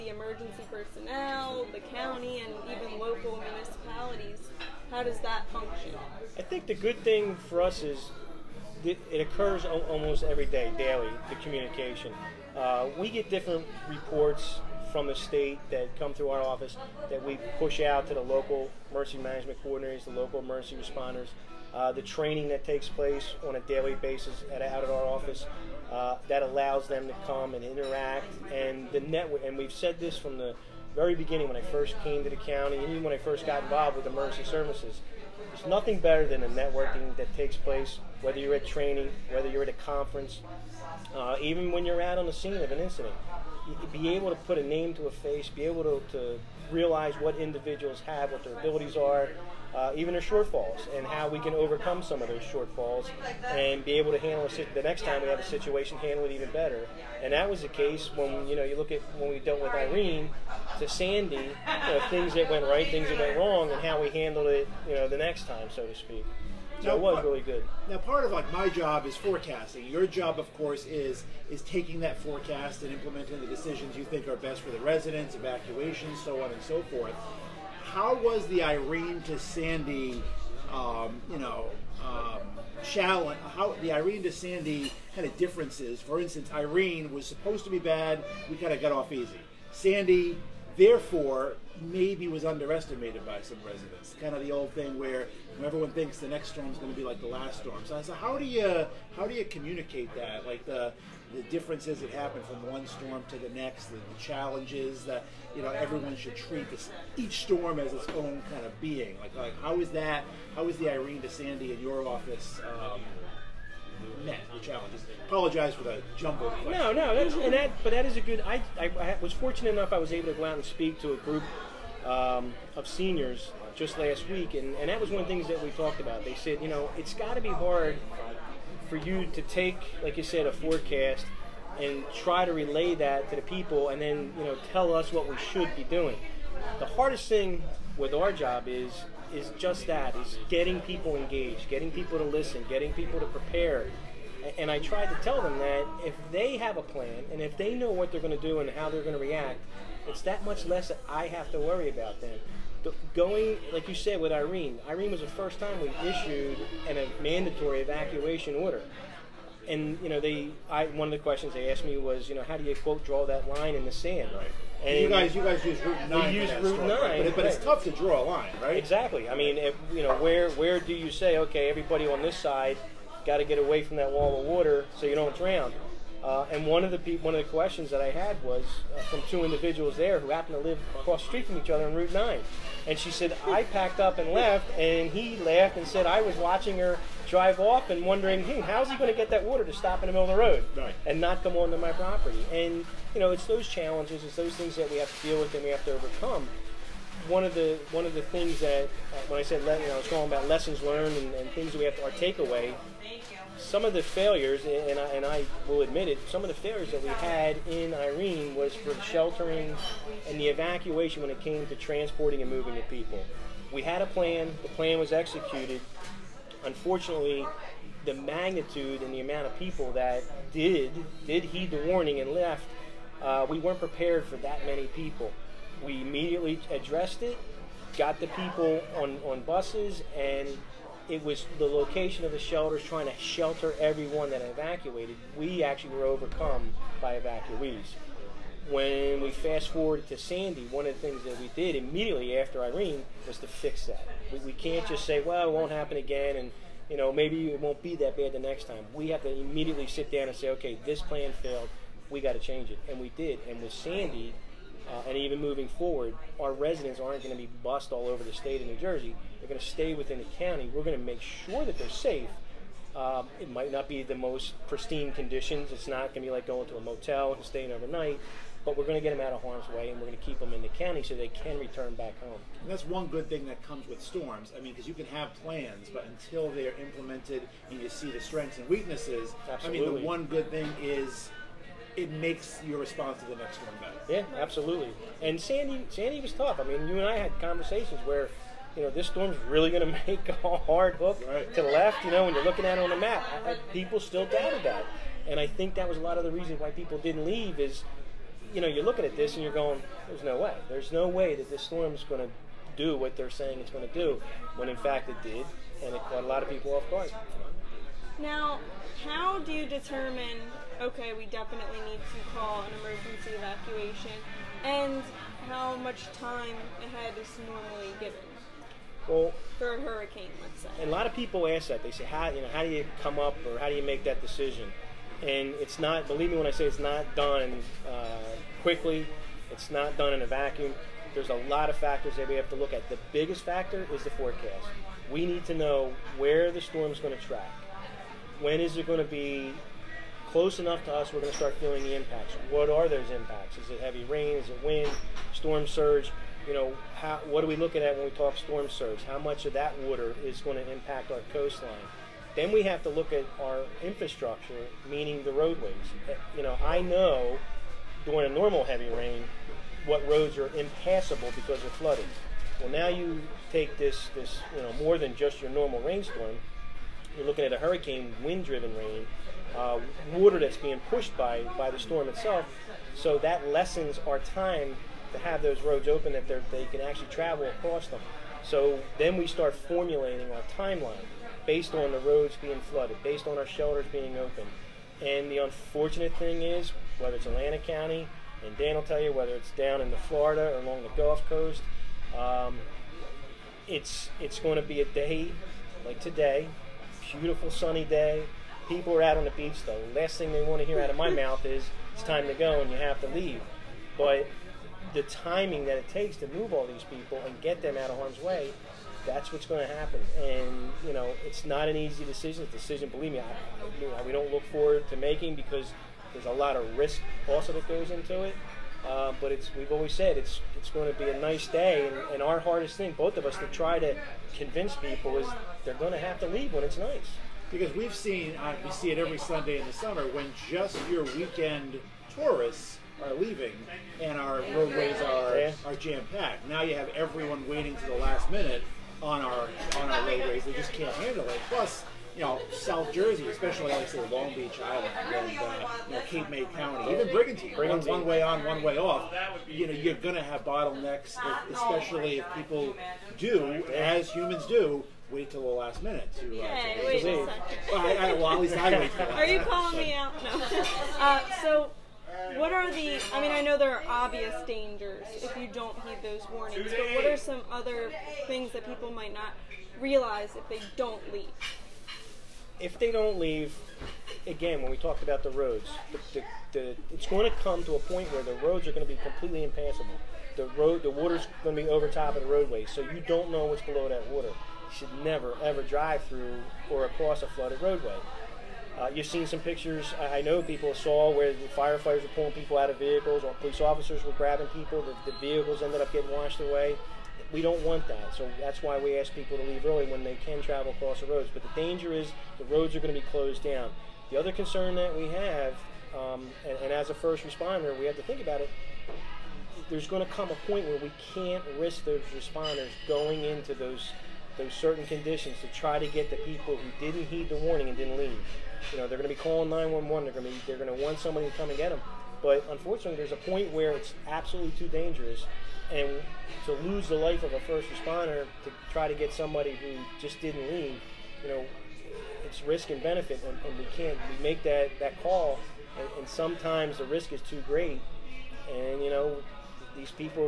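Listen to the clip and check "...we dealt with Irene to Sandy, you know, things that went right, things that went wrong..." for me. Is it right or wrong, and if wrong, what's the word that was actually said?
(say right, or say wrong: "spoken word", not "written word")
right.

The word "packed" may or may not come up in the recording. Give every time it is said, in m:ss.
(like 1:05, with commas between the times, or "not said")
3:03, 7:16.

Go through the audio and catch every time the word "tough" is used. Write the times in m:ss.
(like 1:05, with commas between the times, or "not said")
2:47, 4:46.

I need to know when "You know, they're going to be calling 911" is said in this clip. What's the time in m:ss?
8:38.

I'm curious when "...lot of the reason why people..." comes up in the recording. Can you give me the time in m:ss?
4:56.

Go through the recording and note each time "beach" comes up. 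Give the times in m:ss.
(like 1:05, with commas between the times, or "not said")
6:39, 7:24.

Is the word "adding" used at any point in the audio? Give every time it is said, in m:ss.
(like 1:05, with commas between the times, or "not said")
not said.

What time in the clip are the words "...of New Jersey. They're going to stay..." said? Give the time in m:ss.
4:18.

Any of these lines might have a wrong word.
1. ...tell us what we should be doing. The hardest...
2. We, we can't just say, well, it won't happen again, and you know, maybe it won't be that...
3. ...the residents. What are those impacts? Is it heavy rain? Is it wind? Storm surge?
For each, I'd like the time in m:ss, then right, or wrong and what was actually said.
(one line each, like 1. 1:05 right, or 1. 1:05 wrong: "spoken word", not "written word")
1. 2:14 right
2. 4:04 right
3. 5:41 wrong: "impacts", not "residents".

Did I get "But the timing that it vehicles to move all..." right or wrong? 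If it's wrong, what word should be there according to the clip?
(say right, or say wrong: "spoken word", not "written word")
wrong: "takes", not "vehicles".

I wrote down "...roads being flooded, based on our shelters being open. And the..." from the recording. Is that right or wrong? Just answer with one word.
right.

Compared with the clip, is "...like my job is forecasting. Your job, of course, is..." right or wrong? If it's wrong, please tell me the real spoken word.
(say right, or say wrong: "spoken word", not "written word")
right.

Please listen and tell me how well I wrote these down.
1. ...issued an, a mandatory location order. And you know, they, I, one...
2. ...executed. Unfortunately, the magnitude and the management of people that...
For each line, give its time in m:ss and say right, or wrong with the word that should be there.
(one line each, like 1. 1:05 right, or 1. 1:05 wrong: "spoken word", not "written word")
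1. 2:36 wrong: "evacuation", not "location"
2. 3:35 wrong: "amount", not "management".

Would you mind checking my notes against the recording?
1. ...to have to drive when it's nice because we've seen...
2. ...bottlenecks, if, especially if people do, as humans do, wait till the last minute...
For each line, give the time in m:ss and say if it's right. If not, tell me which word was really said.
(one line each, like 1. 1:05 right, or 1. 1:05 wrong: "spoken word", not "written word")
1. 7:05 wrong: "leave", not "drive"
2. 7:30 right.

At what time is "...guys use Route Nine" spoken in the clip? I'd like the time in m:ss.
2:45.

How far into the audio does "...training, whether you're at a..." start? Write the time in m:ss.
0:38.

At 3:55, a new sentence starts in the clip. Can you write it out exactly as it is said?
We actually were overcome by evacuees.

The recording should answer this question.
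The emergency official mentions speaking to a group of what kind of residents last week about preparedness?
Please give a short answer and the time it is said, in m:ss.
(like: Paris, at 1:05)
seniors, at 2:02.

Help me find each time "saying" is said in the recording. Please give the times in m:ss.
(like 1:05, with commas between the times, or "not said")
5:03.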